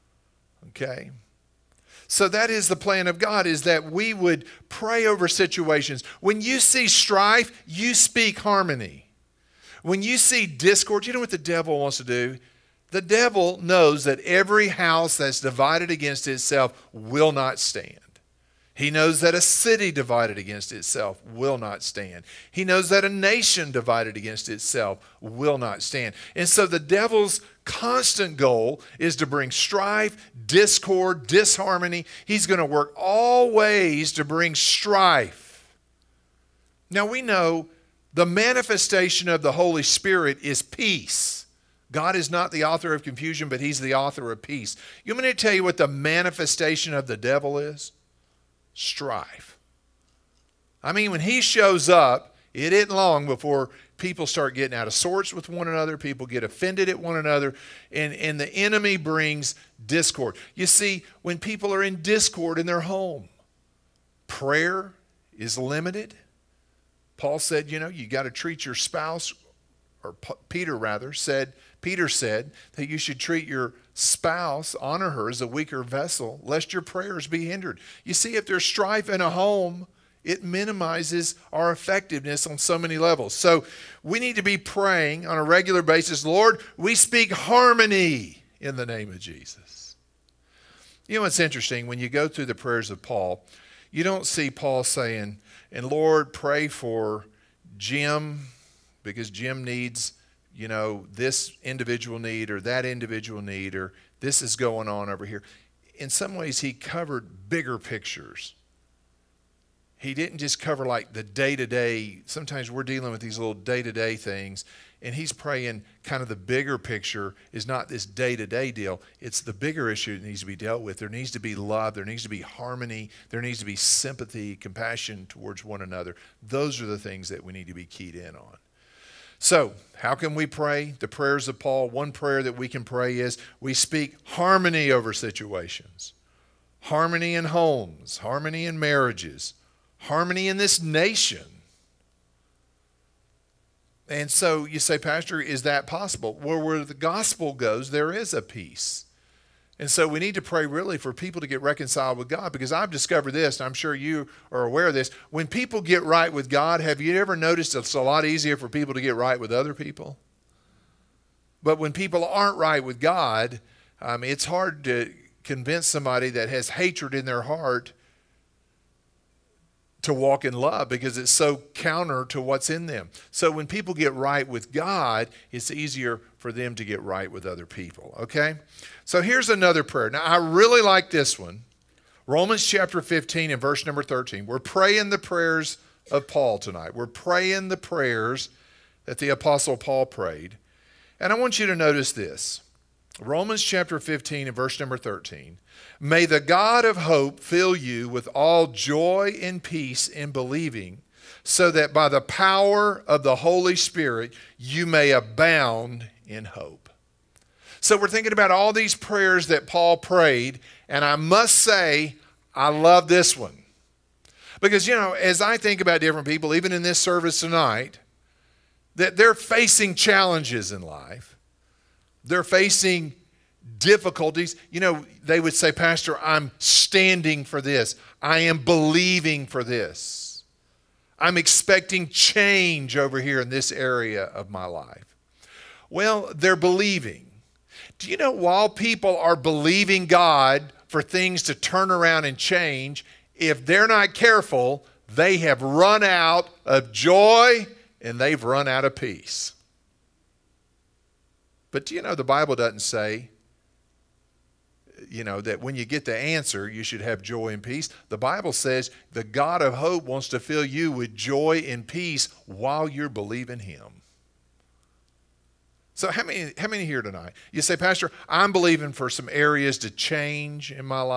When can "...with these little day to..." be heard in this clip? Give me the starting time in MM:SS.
01:53.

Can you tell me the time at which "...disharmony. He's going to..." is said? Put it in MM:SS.
00:31.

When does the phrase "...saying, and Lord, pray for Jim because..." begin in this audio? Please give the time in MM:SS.
01:34.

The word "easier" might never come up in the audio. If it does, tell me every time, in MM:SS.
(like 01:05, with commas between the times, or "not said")
02:38, 02:55.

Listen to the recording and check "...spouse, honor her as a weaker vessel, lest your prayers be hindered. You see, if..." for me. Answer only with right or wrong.
right.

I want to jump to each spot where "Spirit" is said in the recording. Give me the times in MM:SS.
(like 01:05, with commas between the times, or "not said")
00:39, 03:23.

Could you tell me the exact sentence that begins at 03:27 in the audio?
So we're thinking about all these prayers that Paul prayed, and I must say, I love this one.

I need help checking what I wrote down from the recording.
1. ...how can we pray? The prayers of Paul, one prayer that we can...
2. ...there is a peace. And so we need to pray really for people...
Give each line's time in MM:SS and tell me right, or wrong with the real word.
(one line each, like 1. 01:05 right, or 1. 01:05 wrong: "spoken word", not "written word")
1. 02:09 right
2. 02:27 right.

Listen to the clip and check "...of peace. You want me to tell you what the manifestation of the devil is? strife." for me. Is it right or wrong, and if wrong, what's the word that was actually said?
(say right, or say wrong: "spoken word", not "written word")
right.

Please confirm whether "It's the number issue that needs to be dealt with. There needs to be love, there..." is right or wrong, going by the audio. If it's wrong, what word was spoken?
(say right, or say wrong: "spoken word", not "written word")
wrong: "bigger", not "number".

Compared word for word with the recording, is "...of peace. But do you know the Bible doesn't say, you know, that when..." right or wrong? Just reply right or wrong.
right.